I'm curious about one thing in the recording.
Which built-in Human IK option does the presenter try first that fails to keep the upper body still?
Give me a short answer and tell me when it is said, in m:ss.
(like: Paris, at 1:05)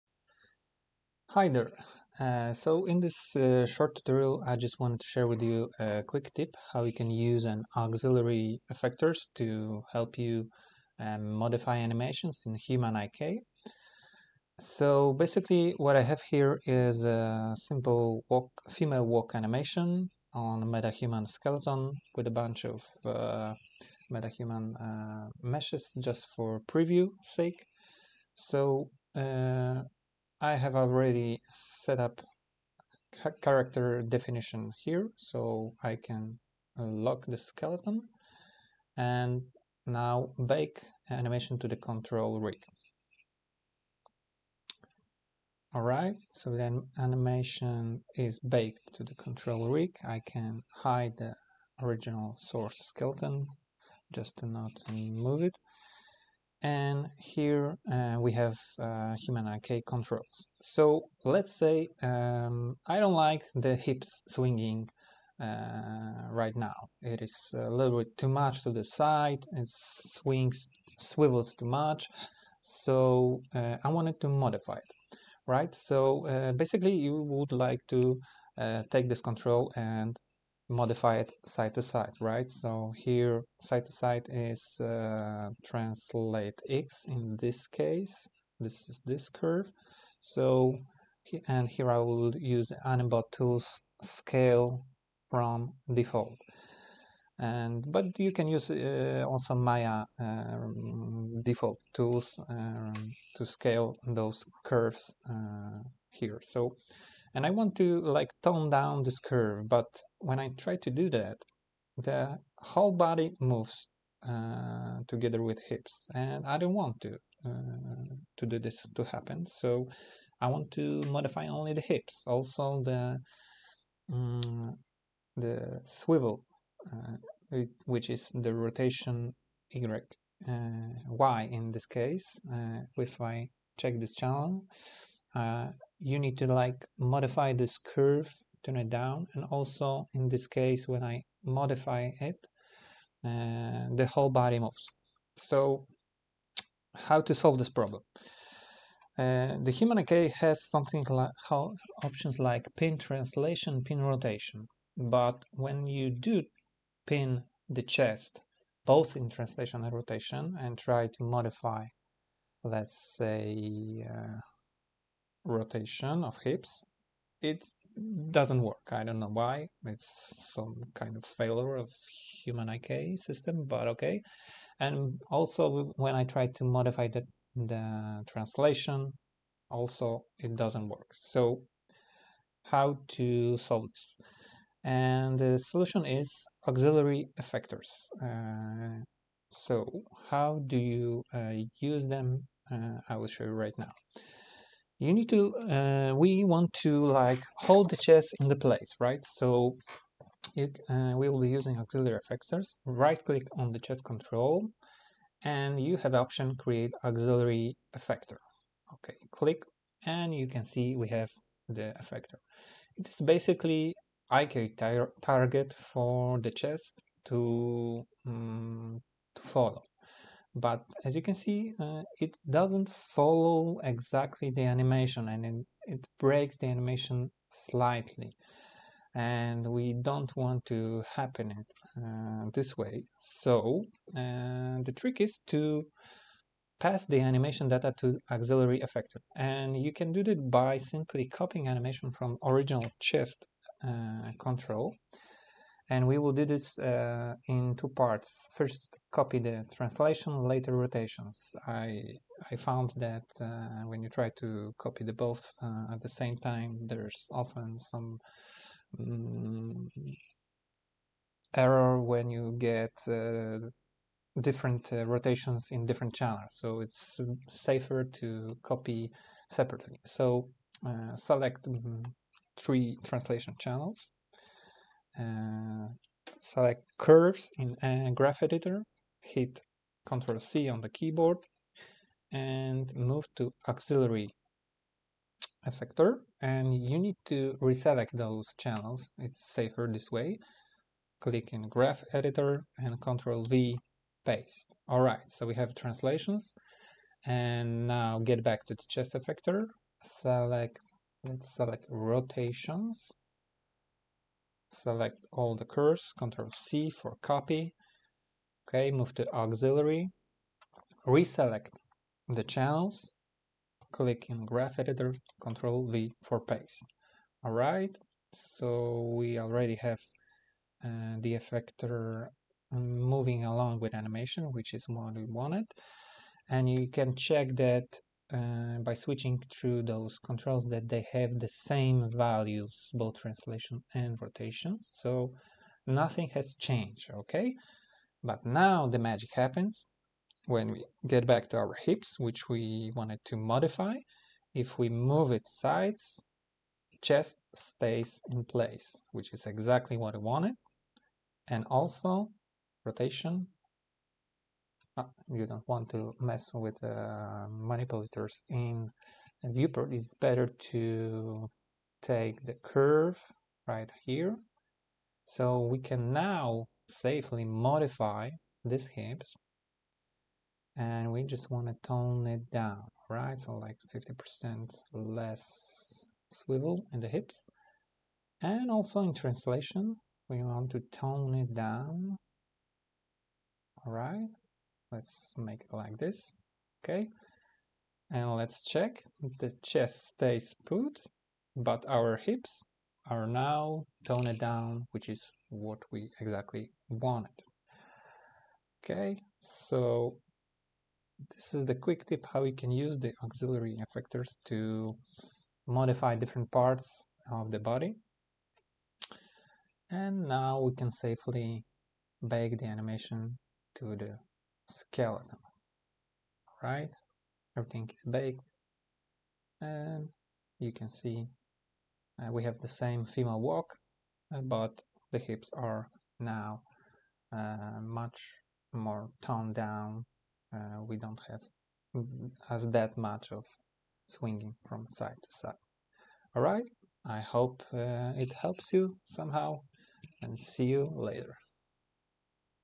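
Pin translation, at 2:32.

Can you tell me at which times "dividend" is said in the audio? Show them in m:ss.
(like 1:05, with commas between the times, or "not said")
not said.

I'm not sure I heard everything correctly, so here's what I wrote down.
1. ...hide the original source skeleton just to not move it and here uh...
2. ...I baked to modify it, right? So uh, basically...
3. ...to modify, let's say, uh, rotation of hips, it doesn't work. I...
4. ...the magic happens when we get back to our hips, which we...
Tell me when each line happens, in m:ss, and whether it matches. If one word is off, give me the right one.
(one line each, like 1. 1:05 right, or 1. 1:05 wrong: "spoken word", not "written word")
1. 0:50 right
2. 1:13 wrong: "wanted", not "baked"
3. 2:41 right
4. 5:38 right.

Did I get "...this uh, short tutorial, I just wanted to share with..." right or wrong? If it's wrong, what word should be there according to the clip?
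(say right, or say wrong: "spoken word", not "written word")
right.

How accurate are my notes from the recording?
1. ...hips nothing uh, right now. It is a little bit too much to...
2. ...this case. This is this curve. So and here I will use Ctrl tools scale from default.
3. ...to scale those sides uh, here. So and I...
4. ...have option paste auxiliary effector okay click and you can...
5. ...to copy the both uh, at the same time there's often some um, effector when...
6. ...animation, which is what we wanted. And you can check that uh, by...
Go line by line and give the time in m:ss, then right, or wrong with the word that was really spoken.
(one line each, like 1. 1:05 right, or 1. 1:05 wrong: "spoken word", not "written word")
1. 1:03 wrong: "swinging", not "nothing"
2. 1:27 wrong: "Animbot", not "Ctrl"
3. 1:43 wrong: "curves", not "sides"
4. 3:25 wrong: "create", not "paste"
5. 4:14 wrong: "error", not "effector"
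6. 5:23 right.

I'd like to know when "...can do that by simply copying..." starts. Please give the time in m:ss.
3:59.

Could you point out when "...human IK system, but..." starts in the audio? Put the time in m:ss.
2:52.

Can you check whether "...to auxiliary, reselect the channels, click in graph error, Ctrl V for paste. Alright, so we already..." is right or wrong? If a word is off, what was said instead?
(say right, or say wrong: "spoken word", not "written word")
wrong: "editor", not "error".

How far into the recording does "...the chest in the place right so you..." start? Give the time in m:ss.
3:17.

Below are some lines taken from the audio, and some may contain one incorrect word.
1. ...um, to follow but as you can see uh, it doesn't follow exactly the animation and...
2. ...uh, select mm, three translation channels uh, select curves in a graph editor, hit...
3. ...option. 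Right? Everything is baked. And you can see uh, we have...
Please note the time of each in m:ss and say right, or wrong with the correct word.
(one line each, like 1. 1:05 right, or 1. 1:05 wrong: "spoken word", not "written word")
1. 3:38 right
2. 4:30 right
3. 6:54 wrong: "skeleton", not "option".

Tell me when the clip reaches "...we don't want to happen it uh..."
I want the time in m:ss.
3:49.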